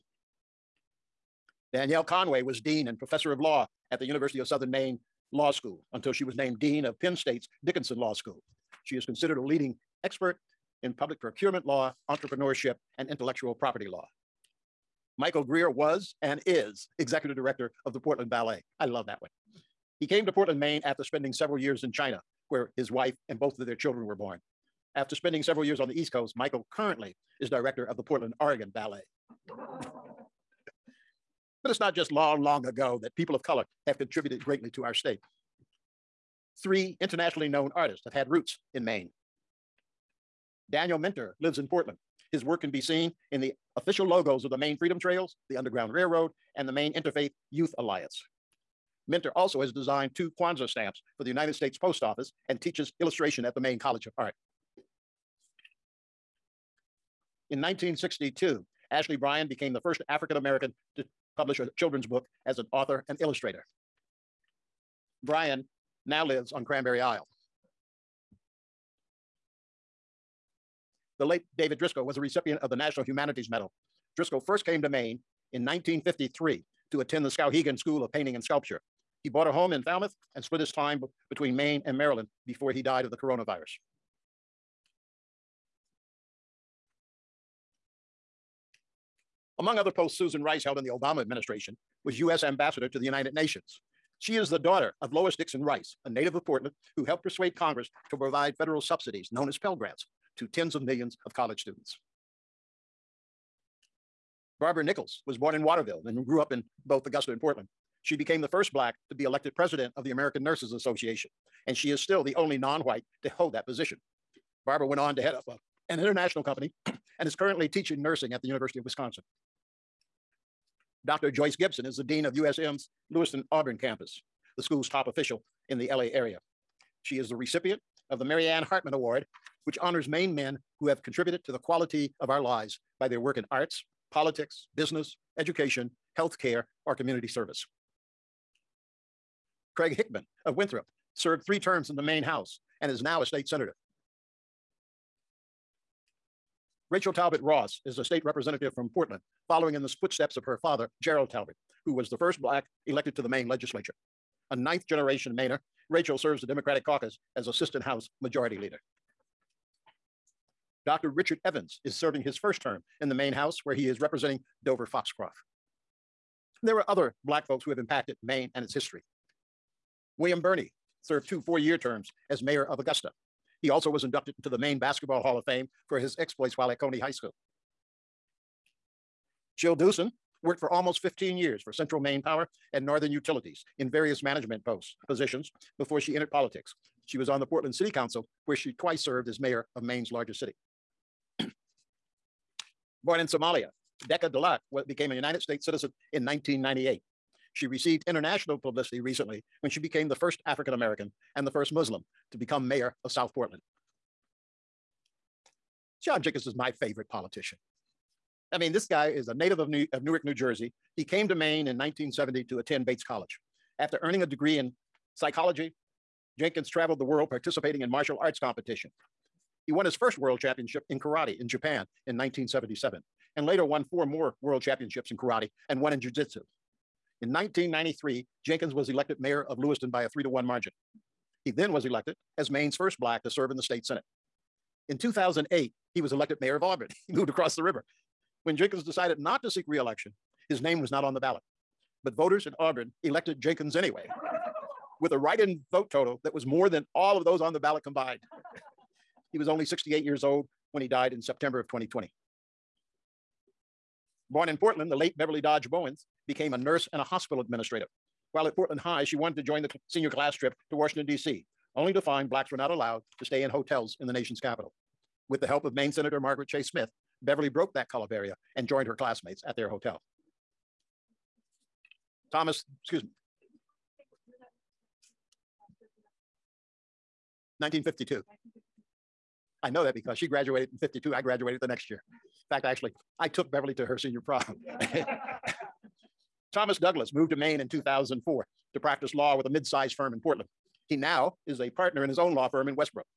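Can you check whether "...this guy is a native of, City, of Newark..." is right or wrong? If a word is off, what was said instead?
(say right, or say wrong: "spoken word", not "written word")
wrong: "New", not "City".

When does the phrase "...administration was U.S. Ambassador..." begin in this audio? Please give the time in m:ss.
1:31.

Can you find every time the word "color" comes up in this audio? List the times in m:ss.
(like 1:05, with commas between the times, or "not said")
0:33, 4:27.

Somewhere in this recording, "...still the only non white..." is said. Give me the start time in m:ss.
1:51.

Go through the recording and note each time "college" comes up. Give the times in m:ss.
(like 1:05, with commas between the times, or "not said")
0:53, 1:41, 3:33.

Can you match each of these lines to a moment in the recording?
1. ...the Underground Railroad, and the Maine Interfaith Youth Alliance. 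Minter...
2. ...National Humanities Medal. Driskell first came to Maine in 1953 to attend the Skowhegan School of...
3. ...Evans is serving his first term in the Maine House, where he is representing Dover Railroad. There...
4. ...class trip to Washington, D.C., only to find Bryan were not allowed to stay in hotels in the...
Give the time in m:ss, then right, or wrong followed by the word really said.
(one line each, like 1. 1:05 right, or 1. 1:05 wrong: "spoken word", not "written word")
1. 0:45 right
2. 1:12 right
3. 2:41 wrong: "Foxcroft", not "Railroad"
4. 4:20 wrong: "Blacks", not "Bryan".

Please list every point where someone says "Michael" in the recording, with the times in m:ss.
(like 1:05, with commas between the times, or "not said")
0:15, 0:26.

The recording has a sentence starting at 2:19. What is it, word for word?
Craig Hickman of Winthrop served three terms in the Maine House and is now a state senator.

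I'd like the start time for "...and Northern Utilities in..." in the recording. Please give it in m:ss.
3:02.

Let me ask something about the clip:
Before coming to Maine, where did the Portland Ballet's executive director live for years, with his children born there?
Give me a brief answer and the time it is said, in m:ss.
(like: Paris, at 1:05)
China, at 0:21.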